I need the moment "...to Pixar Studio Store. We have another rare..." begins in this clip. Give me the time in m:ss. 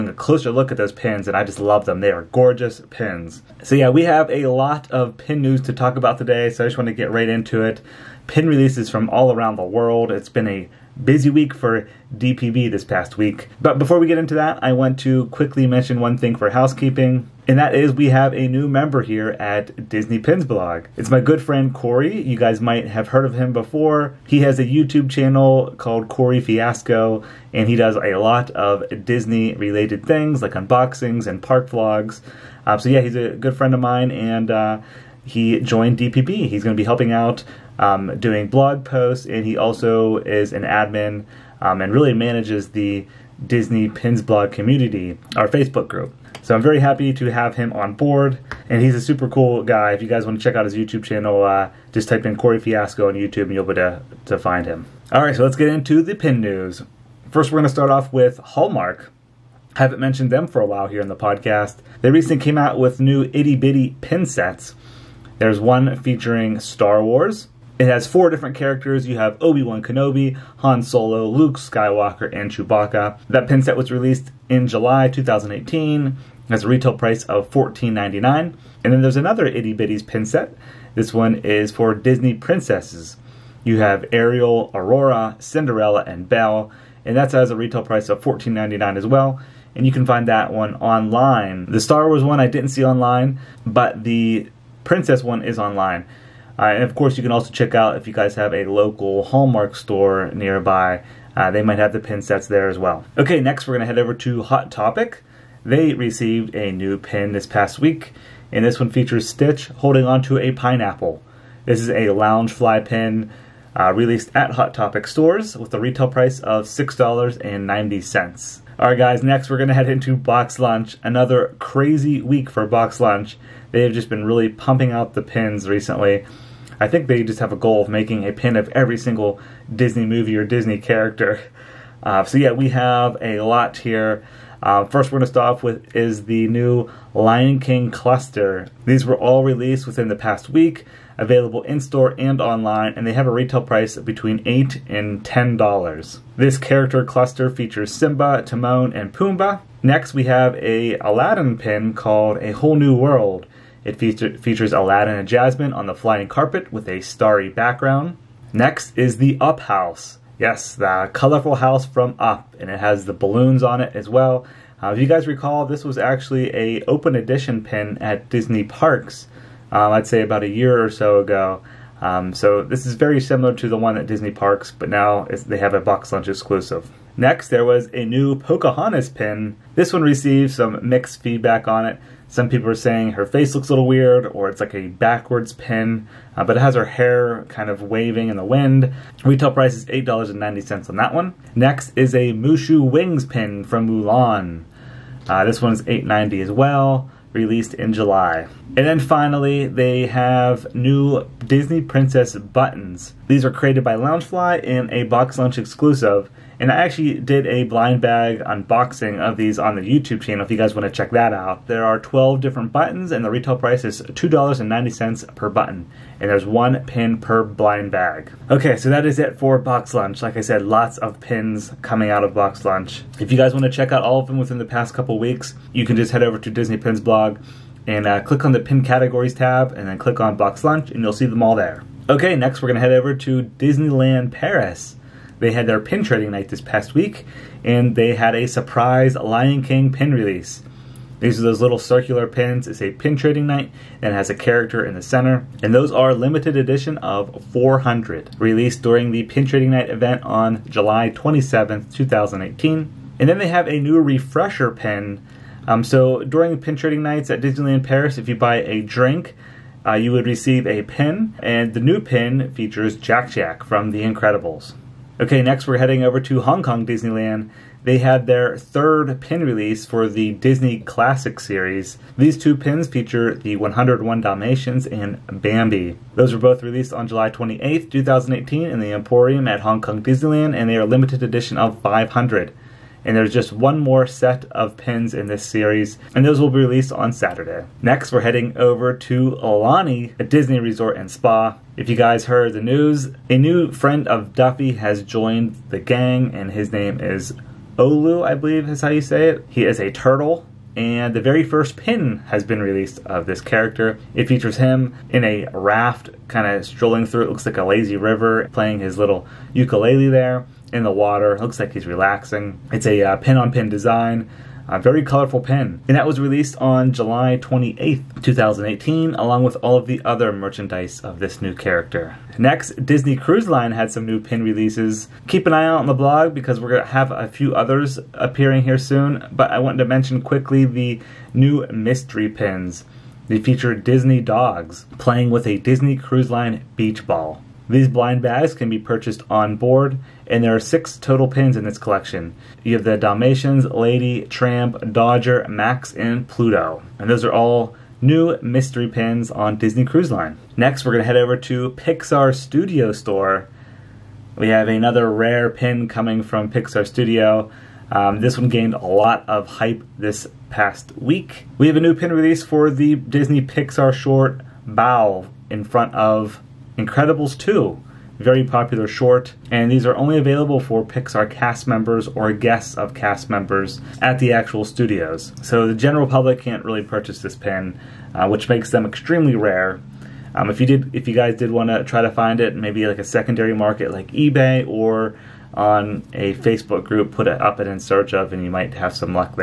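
5:51.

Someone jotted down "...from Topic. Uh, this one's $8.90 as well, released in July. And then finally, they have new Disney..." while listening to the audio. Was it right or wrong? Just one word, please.
wrong.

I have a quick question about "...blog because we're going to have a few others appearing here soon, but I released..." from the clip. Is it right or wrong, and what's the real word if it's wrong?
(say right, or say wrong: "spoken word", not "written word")
wrong: "wanted", not "released".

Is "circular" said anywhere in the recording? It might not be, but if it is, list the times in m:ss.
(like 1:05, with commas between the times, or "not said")
4:01.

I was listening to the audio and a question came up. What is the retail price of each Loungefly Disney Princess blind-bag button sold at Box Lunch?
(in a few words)
$2.90.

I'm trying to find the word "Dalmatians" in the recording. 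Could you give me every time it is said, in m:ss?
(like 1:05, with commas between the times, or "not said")
4:34, 5:42.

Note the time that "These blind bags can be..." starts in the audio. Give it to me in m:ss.
5:37.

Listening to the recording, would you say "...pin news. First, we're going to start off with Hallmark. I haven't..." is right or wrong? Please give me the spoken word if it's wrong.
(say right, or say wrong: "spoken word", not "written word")
right.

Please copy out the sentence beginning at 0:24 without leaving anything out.
He has a YouTube channel called Corey Fiasco, and he does a lot of Disney related things like unboxings and park vlogs.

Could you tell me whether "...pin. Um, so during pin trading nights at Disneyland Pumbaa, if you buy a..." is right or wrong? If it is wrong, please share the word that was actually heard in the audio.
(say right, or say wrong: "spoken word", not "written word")
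wrong: "Paris", not "Pumbaa".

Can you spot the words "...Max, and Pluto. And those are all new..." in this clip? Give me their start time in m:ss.
5:45.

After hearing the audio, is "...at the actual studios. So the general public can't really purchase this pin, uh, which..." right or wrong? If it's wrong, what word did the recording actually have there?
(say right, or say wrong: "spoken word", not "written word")
right.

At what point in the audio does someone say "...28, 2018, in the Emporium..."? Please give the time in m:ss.
4:37.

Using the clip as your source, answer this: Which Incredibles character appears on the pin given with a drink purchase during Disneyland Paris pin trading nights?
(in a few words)
Jack Jack.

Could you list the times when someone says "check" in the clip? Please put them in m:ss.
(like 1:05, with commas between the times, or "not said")
0:50, 1:37, 3:30, 3:43.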